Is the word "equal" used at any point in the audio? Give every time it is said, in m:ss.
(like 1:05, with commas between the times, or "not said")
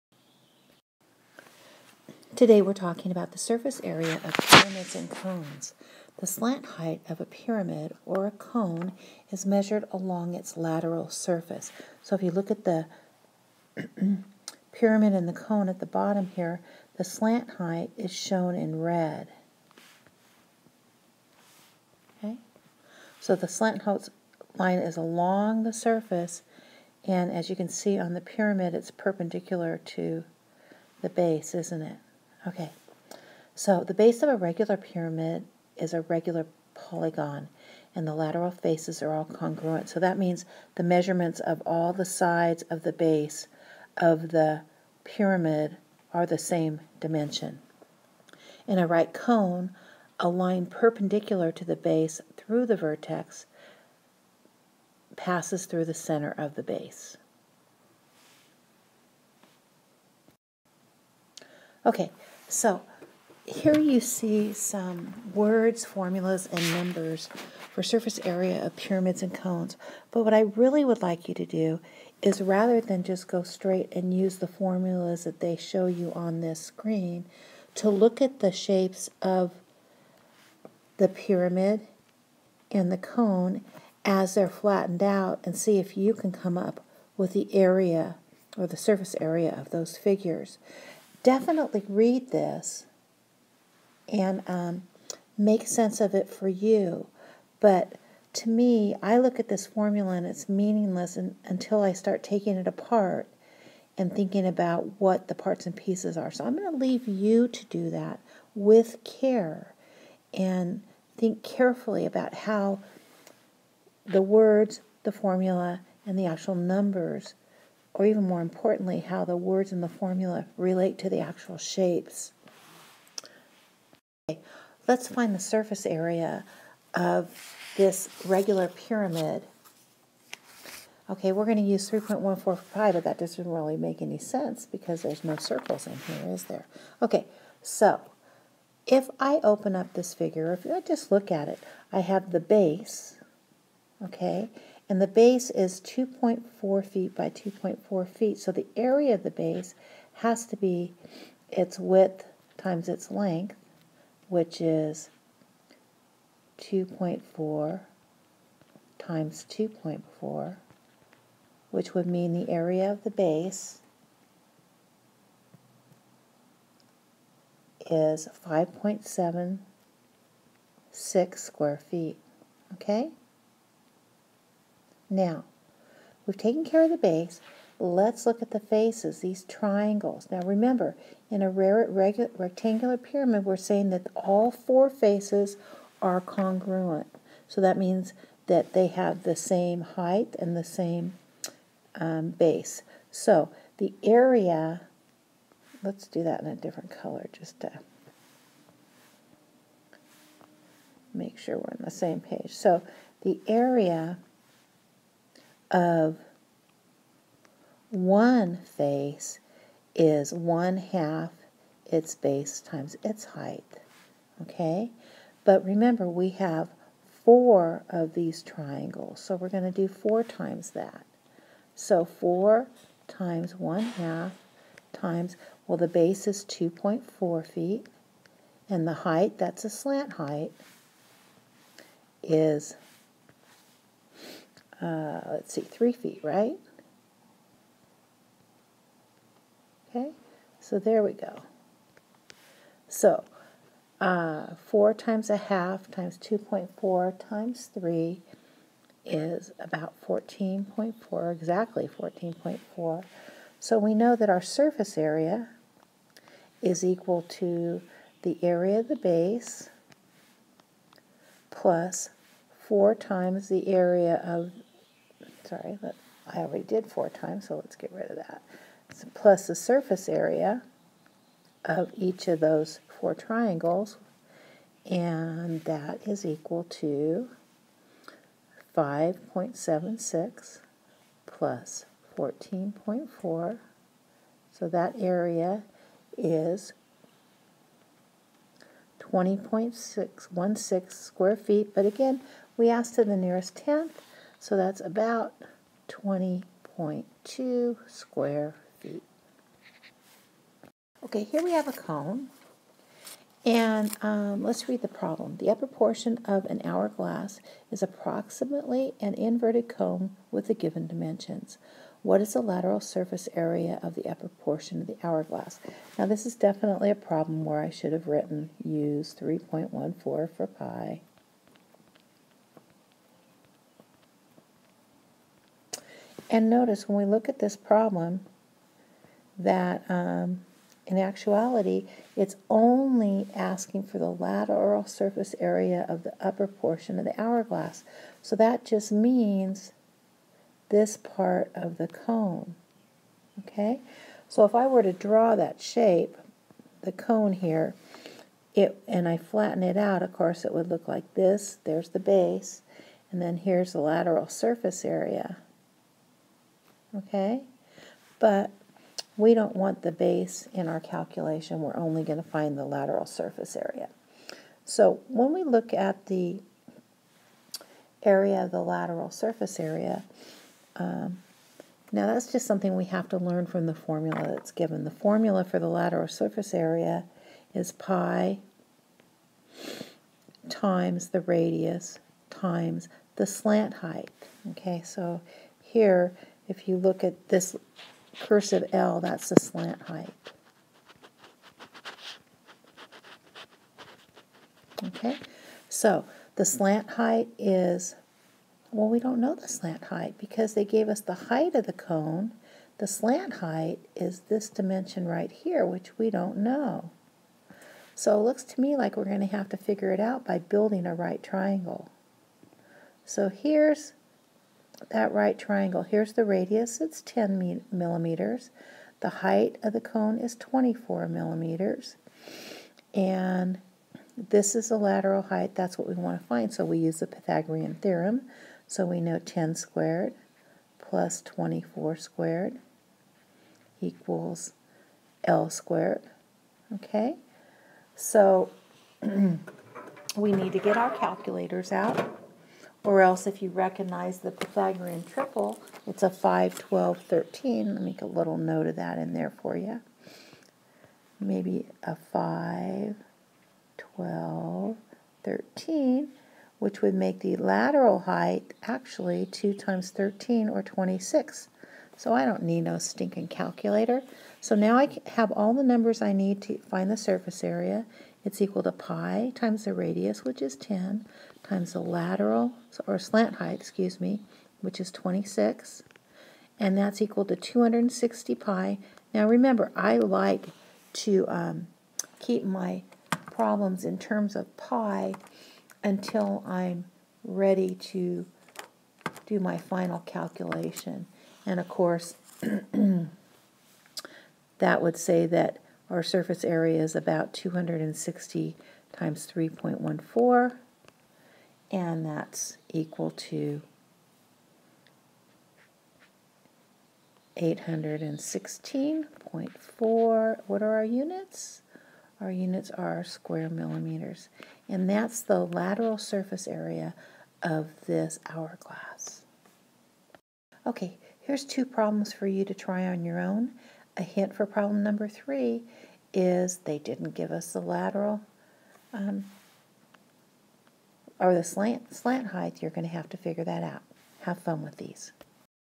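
4:16, 4:36, 7:13, 7:48, 7:57, 8:22.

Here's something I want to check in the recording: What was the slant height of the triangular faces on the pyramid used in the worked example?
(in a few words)
3 feet.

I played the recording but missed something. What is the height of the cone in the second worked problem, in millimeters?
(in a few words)
24 millimeters.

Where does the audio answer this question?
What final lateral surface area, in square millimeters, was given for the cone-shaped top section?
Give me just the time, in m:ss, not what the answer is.
8:27.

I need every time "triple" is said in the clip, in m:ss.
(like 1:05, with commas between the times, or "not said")
7:25.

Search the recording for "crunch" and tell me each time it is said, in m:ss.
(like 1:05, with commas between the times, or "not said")
not said.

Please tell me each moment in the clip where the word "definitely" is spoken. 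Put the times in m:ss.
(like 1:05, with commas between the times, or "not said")
1:31, 5:16.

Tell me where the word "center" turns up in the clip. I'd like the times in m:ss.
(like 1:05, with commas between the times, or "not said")
0:55.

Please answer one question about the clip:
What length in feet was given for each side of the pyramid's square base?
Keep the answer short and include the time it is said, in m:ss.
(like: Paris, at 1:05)
2.4 feet, at 2:25.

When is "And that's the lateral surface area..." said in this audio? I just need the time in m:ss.
8:34.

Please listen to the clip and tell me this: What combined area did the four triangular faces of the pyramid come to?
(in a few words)
14.4.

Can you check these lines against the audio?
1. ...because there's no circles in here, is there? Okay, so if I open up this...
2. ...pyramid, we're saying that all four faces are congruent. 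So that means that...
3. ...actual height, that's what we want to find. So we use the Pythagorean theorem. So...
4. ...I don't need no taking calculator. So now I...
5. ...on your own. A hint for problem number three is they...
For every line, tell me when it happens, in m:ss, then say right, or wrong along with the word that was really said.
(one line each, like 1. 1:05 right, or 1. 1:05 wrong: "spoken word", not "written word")
1. 2:14 right
2. 3:02 right
3. 7:04 wrong: "lateral", not "actual"
4. 7:42 wrong: "stinking", not "taking"
5. 8:42 right.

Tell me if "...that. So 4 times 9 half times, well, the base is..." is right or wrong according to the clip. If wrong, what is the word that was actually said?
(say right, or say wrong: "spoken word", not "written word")
wrong: "1", not "9".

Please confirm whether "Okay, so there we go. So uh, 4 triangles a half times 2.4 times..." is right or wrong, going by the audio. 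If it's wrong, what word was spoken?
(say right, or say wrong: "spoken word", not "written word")
wrong: "times", not "triangles".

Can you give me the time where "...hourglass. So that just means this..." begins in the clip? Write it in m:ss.
5:37.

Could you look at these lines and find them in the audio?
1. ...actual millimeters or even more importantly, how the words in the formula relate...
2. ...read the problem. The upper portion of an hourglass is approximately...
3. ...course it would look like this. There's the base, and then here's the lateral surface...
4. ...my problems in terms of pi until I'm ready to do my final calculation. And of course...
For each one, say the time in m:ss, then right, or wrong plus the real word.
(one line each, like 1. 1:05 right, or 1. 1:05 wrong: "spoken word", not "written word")
1. 1:56 wrong: "numbers", not "millimeters"
2. 5:04 right
3. 5:50 right
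4. 8:02 right.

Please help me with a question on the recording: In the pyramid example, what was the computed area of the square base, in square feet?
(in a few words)
5.76.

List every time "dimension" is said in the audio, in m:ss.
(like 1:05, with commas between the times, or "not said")
0:46, 5:10, 6:44.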